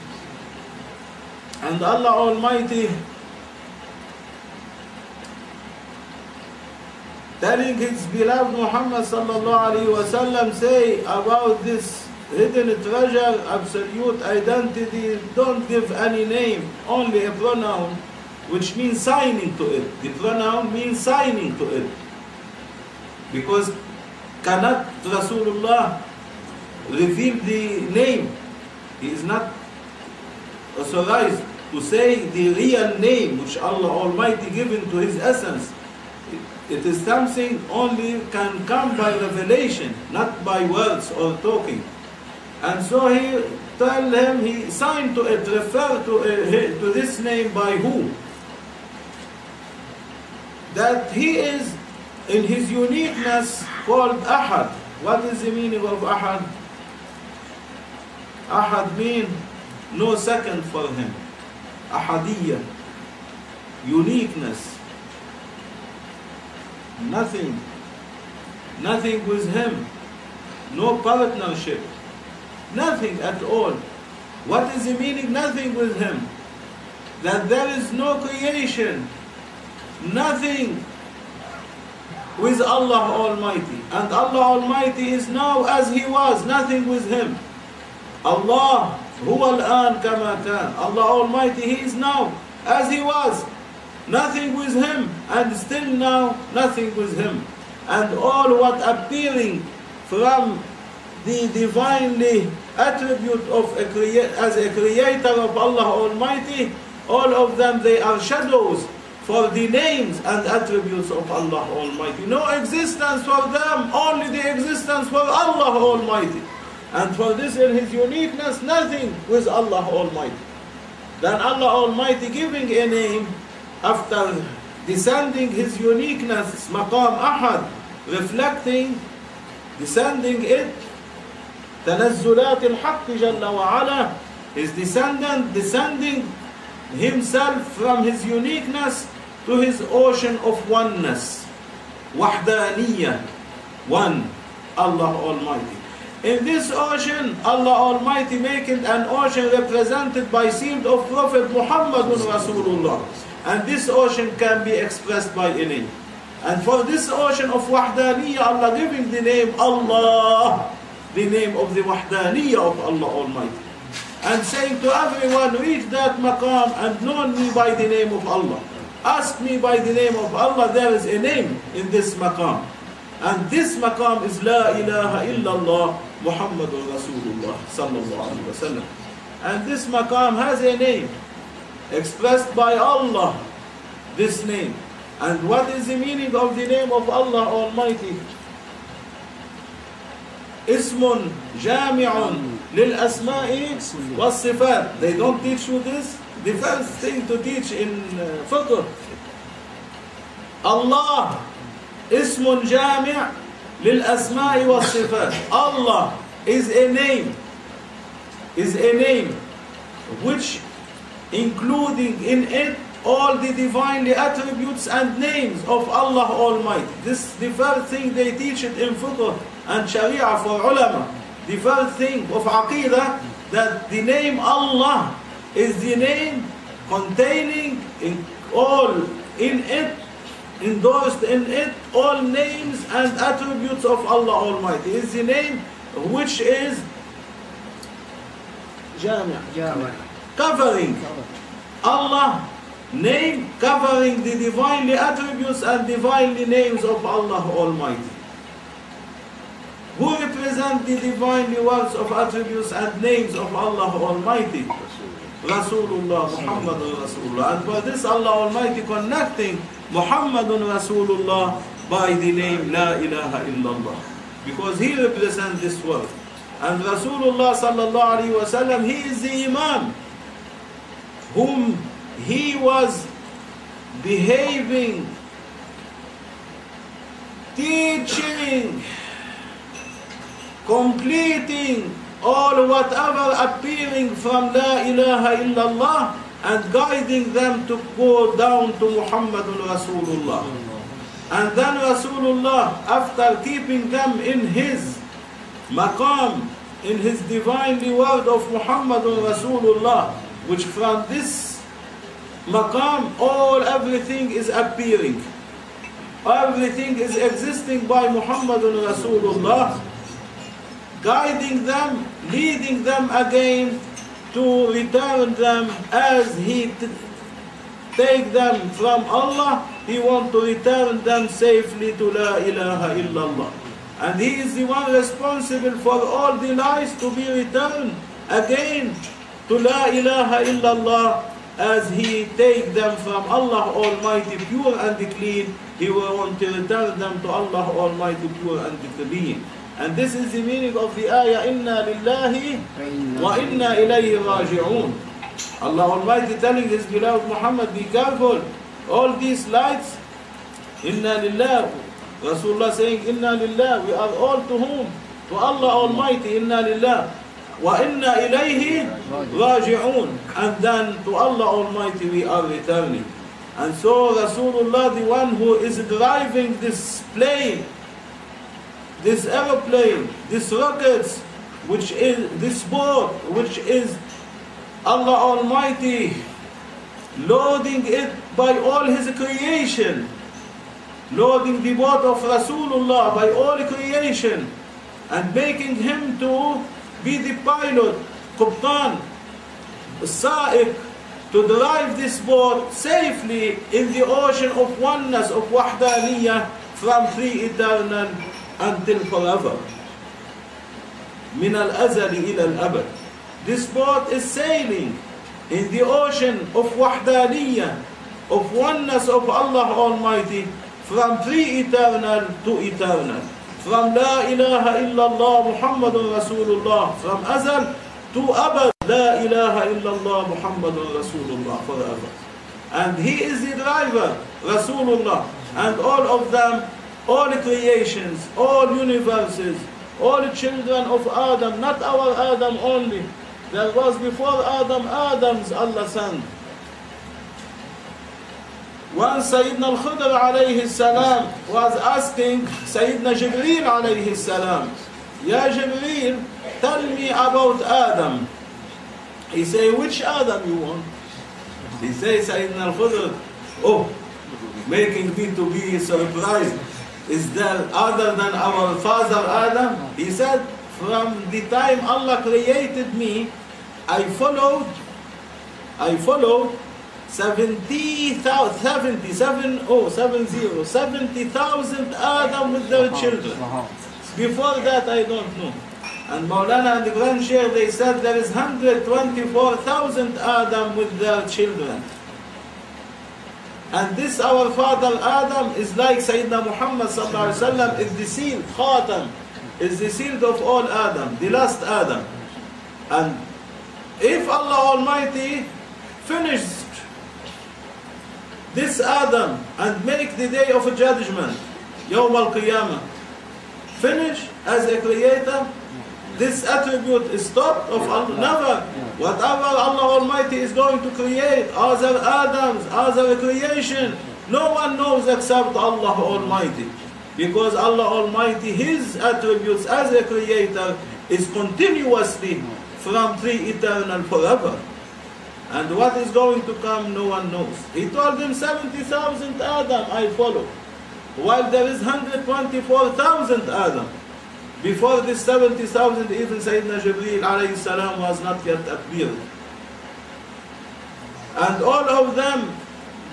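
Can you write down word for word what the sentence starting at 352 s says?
Rasulullah saying, Inna lillahi, we are all to whom?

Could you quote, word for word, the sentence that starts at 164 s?
And saying to everyone, reach that maqam and know me by the name of Allah.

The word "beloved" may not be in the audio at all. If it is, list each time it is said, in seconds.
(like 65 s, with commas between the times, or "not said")
8 s, 346 s.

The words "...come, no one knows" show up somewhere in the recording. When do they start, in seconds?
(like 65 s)
526 s.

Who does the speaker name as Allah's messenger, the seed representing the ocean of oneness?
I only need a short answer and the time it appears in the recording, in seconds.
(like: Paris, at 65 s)
Prophet Muhammad, at 151 s.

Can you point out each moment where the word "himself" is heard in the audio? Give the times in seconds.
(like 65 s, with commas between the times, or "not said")
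136 s.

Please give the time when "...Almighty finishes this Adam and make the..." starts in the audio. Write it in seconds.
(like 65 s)
494 s.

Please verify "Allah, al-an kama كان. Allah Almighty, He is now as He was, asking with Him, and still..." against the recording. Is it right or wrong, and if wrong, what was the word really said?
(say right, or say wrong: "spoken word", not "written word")
wrong: "nothing", not "asking".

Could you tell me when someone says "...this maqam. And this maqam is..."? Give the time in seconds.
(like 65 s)
171 s.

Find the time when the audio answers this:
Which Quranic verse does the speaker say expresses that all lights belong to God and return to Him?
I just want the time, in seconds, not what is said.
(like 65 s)
341 s.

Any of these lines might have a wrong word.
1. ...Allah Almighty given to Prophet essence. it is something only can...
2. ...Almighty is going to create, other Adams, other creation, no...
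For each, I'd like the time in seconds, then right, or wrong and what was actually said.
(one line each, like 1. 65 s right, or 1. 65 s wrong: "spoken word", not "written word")
1. 33 s wrong: "His", not "Prophet"
2. 509 s right.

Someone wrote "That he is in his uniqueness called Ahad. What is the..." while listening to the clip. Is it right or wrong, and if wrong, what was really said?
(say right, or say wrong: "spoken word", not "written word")
right.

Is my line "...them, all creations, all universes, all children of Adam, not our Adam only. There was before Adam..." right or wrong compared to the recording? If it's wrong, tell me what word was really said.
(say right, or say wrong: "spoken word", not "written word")
right.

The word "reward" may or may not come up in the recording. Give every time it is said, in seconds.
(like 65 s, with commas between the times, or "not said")
297 s.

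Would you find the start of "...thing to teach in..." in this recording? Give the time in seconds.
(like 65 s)
197 s.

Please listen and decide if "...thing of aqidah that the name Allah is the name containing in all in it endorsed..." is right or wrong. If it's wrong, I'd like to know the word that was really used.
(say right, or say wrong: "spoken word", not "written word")
right.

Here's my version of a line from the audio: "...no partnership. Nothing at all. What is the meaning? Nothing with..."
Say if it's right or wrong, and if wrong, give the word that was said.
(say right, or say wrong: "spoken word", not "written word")
right.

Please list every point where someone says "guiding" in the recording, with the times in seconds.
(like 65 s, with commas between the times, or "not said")
286 s, 311 s.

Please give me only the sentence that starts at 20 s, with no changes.
The pronoun means signing to it.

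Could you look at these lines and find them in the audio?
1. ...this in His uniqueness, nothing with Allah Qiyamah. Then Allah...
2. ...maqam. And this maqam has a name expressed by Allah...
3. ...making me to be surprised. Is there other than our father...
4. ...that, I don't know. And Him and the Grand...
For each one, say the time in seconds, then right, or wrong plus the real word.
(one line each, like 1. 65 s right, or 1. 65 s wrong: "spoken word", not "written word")
1. 117 s wrong: "Almighty", not "Qiyamah"
2. 178 s wrong: "wasallam", not "maqam"
3. 454 s right
4. 474 s wrong: "Maulana", not "Him".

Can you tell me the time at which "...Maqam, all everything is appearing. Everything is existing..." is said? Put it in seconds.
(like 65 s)
302 s.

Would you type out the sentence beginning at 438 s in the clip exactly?
When Sayyidina al-Khudr alayhi salam was asking Sayyidina Jibreel alayhi salam, Ya Jibreel, tell me about Adam.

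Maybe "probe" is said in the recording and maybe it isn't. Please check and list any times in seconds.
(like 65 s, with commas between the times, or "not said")
not said.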